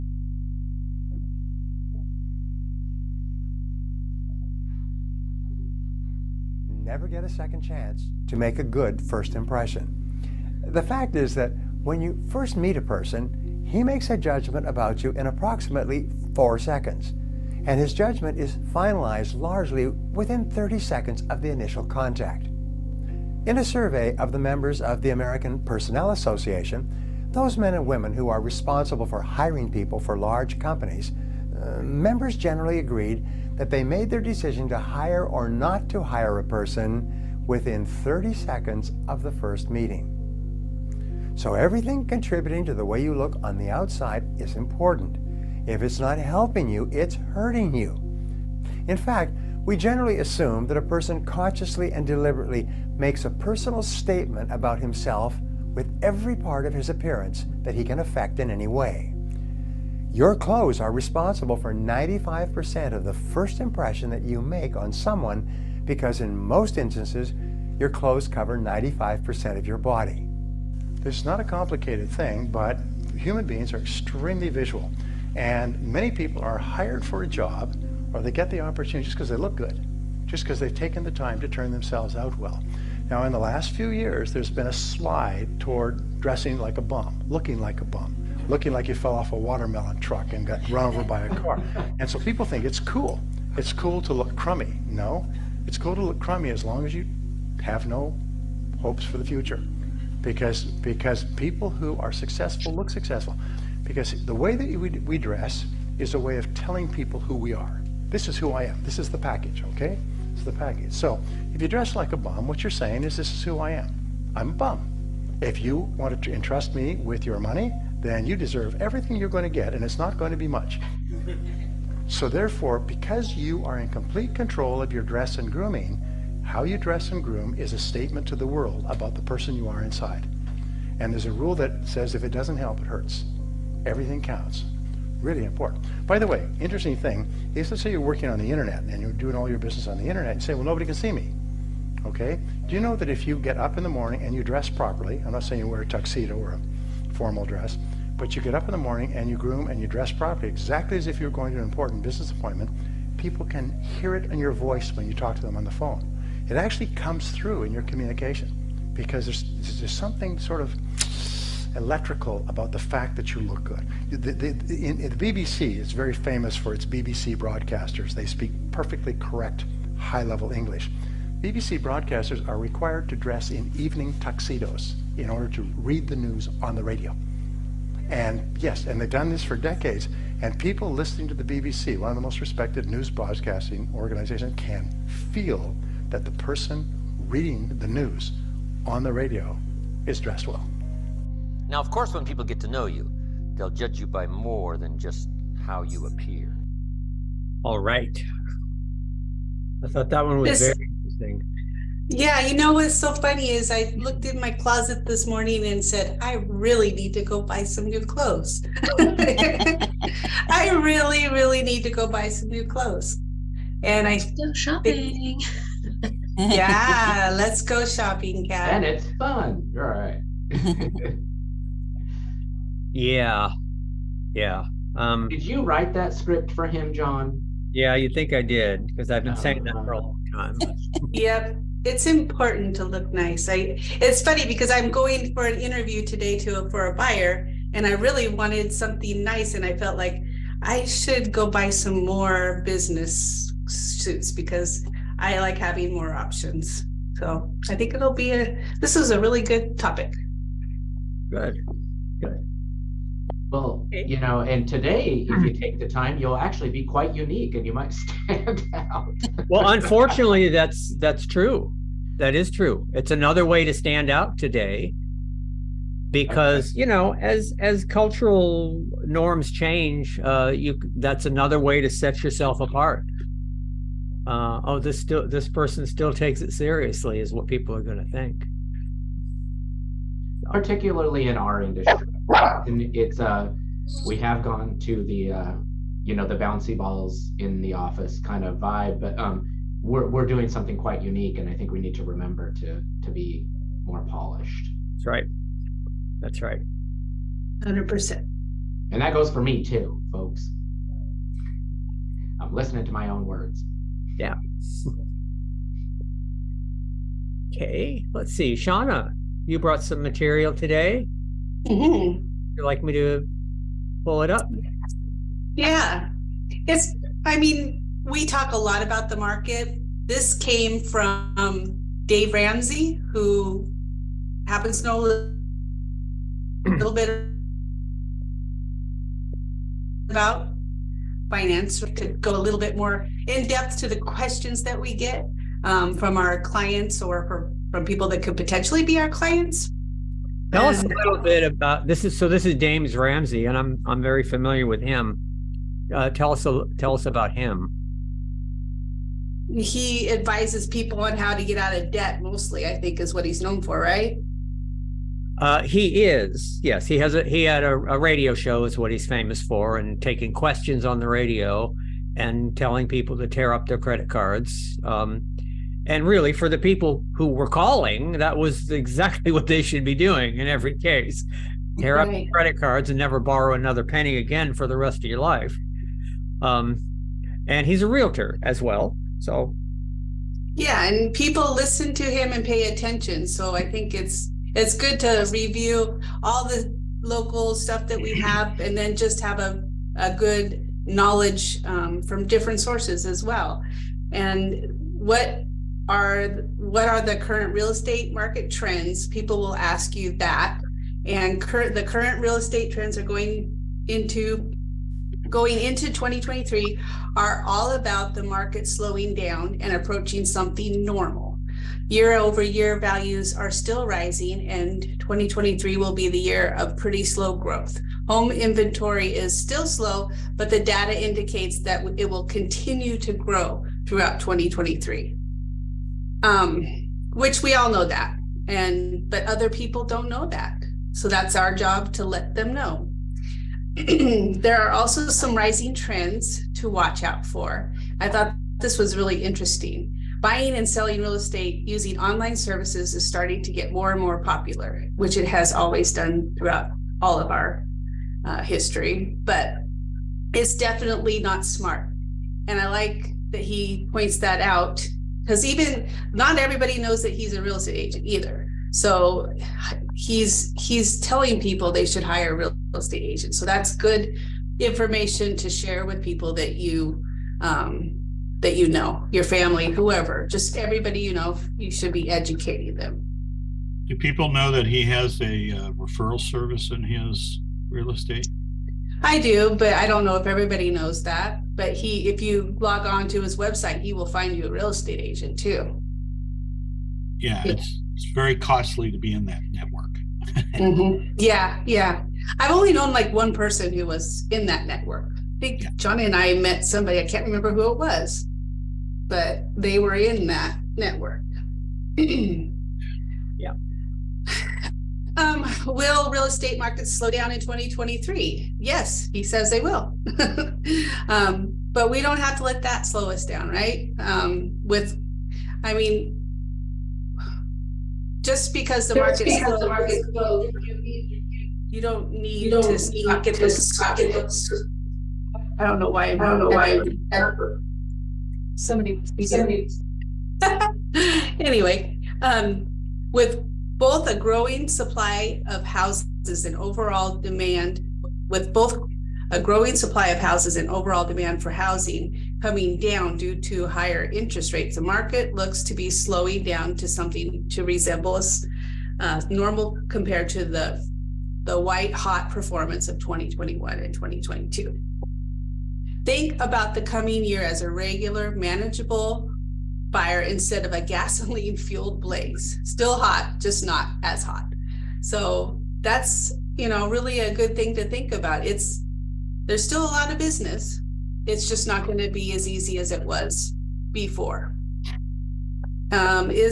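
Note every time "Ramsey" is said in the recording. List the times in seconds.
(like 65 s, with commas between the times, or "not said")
322 s, 342 s.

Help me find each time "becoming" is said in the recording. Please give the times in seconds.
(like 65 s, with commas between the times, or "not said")
not said.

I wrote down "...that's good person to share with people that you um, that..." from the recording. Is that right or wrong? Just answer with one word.
wrong.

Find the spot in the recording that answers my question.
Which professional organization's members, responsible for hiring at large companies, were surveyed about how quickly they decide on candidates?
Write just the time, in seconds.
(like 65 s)
25 s.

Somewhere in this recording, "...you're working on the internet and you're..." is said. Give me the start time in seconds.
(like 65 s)
137 s.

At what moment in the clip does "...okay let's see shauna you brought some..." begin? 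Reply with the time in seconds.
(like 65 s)
307 s.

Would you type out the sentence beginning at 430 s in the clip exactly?
So that's our job to let them know.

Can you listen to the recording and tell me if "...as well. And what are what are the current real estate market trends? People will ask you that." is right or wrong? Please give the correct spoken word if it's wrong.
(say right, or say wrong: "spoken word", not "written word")
right.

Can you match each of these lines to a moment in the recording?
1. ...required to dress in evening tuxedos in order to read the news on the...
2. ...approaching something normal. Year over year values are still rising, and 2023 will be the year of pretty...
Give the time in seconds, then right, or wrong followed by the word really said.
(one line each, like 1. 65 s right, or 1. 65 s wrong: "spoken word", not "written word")
1. 172 s right
2. 409 s right.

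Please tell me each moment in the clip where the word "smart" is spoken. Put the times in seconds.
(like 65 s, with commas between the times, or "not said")
451 s.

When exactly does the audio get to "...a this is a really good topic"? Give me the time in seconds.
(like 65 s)
248 s.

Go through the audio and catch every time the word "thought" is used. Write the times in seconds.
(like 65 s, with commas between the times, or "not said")
199 s, 438 s.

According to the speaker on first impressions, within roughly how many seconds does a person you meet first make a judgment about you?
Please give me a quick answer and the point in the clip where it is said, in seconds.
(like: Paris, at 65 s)
4 seconds, at 16 s.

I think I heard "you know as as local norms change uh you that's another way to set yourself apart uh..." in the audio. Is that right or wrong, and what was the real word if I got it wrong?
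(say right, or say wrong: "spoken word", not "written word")
wrong: "cultural", not "local".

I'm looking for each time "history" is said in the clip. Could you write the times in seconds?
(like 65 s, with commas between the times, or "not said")
448 s.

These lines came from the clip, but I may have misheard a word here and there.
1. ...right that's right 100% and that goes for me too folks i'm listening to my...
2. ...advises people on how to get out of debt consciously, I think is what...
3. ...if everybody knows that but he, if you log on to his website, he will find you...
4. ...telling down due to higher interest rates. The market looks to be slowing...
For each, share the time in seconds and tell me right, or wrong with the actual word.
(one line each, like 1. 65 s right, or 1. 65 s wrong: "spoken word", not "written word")
1. 295 s right
2. 350 s wrong: "mostly", not "consciously"
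3. 480 s right
4. 542 s wrong: "coming", not "telling".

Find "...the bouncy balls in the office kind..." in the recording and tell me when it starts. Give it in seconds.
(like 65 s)
286 s.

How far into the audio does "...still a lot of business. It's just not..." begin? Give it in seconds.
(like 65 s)
569 s.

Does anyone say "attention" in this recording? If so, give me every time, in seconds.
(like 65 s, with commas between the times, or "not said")
382 s.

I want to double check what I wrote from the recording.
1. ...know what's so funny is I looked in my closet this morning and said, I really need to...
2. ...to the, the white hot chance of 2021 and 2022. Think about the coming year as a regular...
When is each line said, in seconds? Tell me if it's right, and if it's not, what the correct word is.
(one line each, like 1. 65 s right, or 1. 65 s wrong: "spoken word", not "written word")
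1. 202 s right
2. 550 s wrong: "performance", not "chance".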